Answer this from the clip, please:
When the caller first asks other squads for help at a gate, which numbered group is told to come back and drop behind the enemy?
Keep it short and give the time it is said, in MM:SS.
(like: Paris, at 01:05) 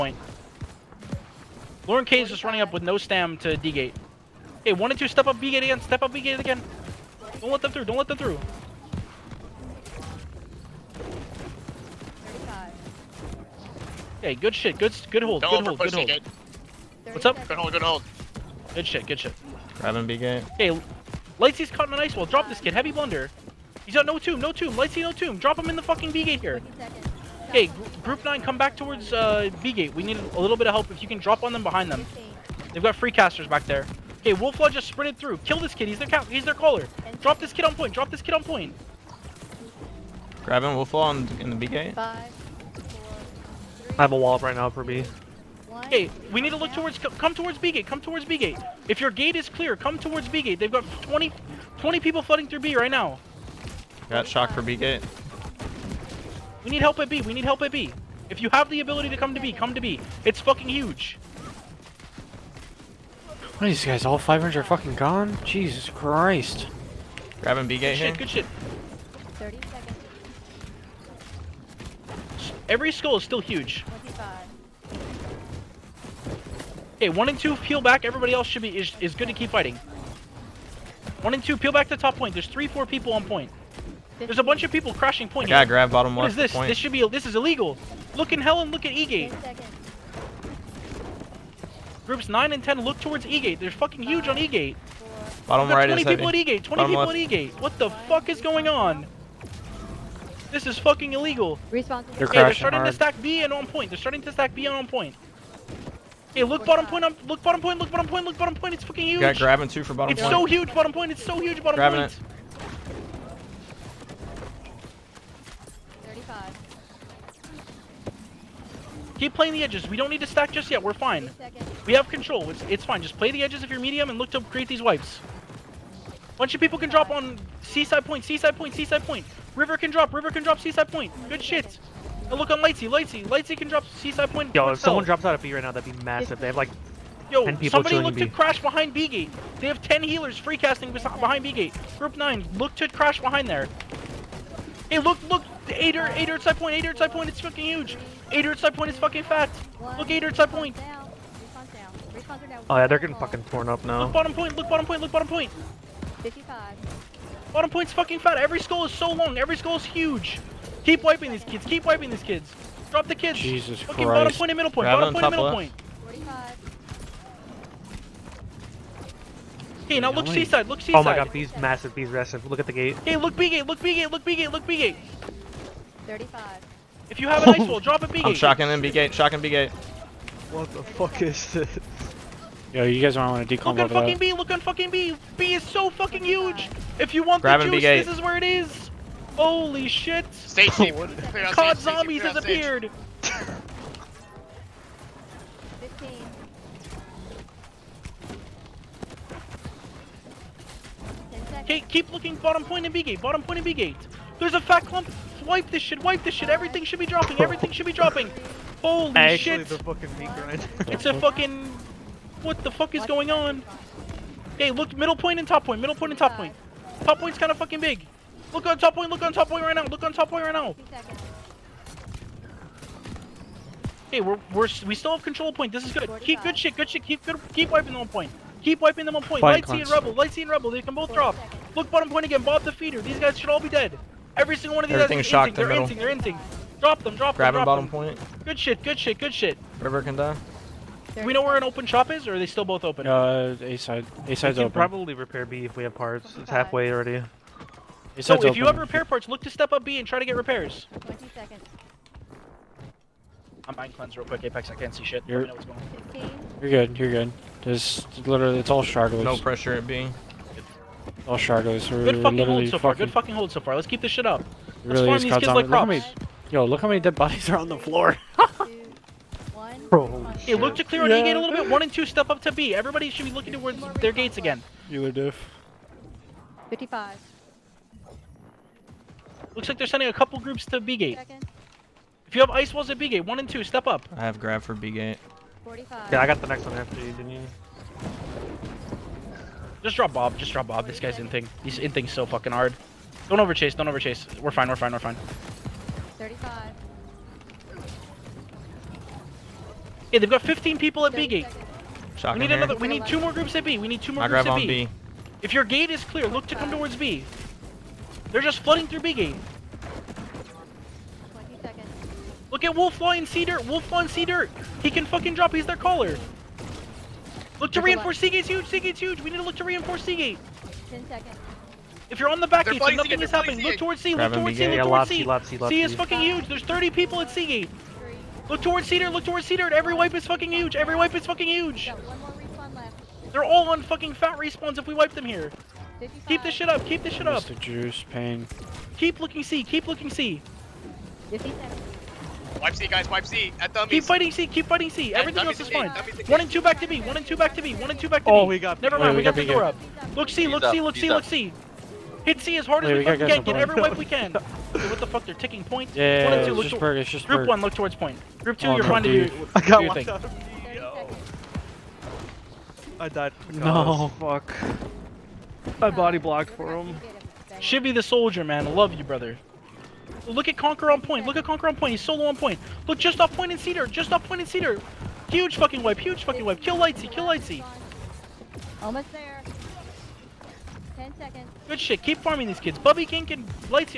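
Group 9, at 00:28.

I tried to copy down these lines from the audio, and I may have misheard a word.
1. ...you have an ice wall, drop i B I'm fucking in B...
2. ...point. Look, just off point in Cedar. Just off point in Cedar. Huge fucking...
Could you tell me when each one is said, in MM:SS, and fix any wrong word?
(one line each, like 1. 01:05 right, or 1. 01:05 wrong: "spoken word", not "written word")
1. 02:57 wrong: "shocking", not "fucking"
2. 06:12 right.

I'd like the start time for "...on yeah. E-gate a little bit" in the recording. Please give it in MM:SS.
04:31.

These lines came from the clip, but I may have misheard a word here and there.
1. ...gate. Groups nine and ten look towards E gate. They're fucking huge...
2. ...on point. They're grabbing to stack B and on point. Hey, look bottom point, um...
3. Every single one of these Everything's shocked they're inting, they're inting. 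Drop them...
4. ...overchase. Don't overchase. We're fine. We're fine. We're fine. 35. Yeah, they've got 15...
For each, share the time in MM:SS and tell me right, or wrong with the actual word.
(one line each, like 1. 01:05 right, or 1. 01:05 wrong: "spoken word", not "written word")
1. 01:29 right
2. 01:43 wrong: "starting", not "grabbing"
3. 03:54 right
4. 04:53 right.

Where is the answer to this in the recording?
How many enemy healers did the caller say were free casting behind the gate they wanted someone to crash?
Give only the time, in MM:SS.
02:19.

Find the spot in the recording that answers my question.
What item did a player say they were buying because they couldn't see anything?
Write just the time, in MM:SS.
04:13.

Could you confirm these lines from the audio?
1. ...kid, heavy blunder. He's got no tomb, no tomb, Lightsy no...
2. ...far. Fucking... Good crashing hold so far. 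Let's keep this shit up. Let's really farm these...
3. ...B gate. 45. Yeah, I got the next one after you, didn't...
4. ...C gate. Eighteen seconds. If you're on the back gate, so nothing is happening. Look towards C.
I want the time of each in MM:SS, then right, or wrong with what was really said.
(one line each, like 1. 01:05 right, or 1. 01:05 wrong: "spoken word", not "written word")
1. 00:22 right
2. 04:22 wrong: "fucking", not "crashing"
3. 04:44 right
4. 05:20 wrong: "Ten", not "Eighteen".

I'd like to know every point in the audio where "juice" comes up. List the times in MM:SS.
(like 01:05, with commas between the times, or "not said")
03:07, 05:37.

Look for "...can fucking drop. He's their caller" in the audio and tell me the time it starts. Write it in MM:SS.
05:14.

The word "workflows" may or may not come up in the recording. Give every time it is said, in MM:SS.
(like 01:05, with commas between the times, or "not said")
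not said.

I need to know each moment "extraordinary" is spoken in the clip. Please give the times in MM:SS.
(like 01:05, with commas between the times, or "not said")
not said.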